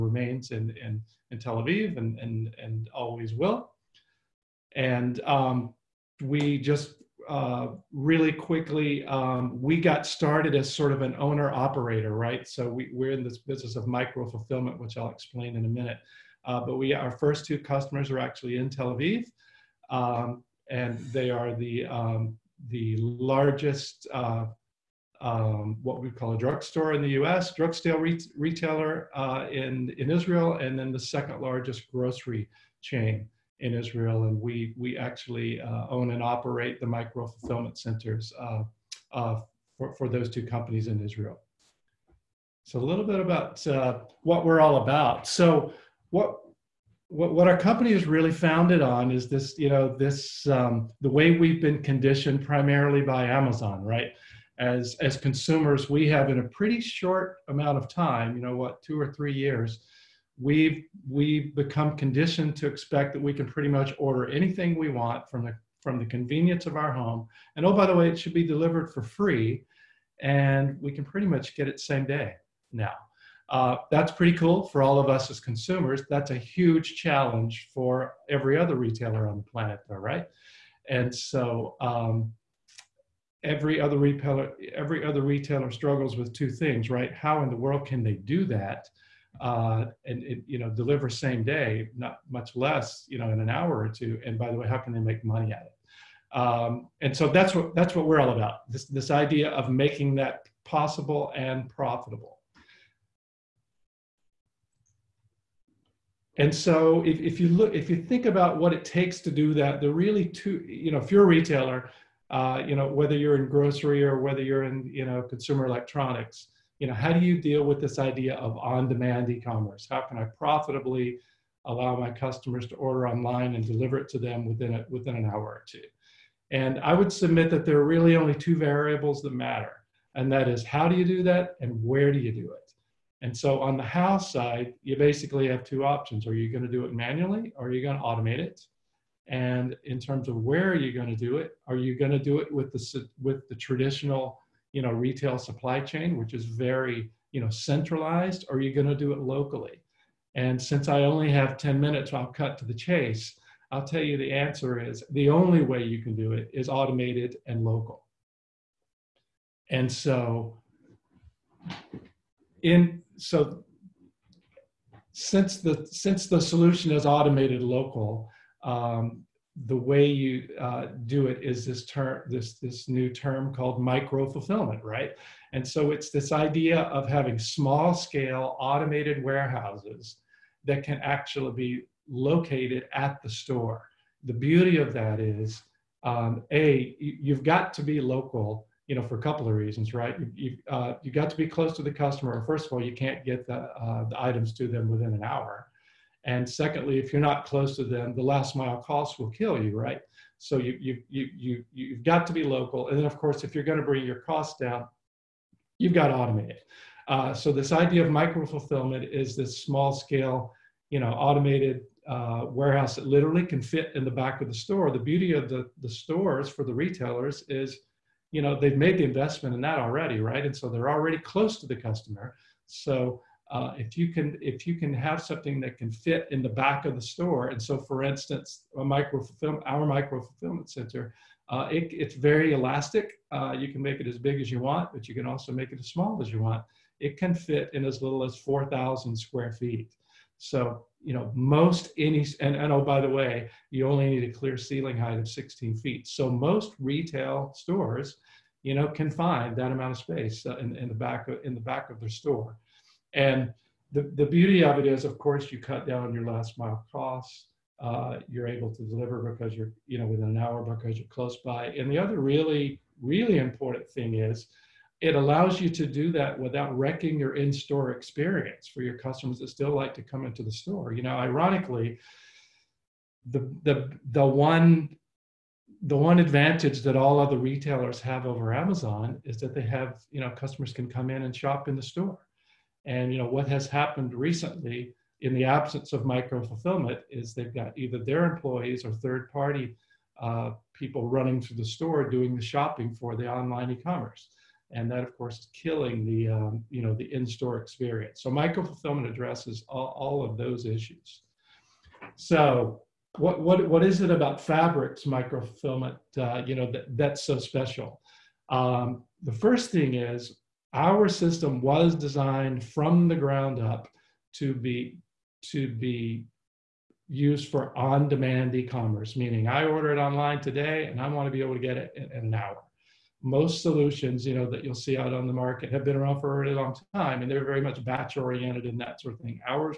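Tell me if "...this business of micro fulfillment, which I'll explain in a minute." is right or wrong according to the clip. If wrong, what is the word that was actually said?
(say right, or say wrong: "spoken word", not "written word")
right.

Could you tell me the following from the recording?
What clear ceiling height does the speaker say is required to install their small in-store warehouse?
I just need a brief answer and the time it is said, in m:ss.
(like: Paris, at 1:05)
16 feet, at 4:05.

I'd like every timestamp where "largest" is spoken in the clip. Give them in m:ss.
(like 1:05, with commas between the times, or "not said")
0:22, 0:31.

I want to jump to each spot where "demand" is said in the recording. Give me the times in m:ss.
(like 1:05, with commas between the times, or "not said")
1:58, 5:17.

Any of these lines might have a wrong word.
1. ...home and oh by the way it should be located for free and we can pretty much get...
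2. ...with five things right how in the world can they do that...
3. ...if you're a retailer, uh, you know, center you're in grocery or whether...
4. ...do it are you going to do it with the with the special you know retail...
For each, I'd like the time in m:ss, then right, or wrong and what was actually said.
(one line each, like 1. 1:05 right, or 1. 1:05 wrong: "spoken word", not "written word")
1. 1:06 wrong: "delivered", not "located"
2. 1:26 wrong: "two", not "five"
3. 1:50 wrong: "whether", not "center"
4. 2:21 wrong: "traditional", not "special".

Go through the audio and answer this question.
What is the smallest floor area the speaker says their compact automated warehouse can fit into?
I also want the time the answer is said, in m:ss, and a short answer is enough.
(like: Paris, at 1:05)
4000 square feet, at 3:58.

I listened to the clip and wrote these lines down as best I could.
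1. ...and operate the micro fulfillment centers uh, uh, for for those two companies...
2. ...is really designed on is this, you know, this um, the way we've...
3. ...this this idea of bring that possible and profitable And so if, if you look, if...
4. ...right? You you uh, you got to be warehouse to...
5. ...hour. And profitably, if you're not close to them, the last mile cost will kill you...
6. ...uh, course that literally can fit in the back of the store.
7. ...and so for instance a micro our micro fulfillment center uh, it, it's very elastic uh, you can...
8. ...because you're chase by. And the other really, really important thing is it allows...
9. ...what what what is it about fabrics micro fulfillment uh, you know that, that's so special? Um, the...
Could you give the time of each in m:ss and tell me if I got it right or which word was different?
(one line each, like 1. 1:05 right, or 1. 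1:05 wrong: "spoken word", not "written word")
1. 0:36 right
2. 0:47 wrong: "founded", not "designed"
3. 1:38 wrong: "making", not "bring"
4. 3:09 wrong: "close", not "warehouse"
5. 3:15 wrong: "secondly", not "profitably"
6. 3:32 wrong: "warehouse", not "course"
7. 3:47 right
8. 4:20 wrong: "close", not "chase"
9. 5:03 right.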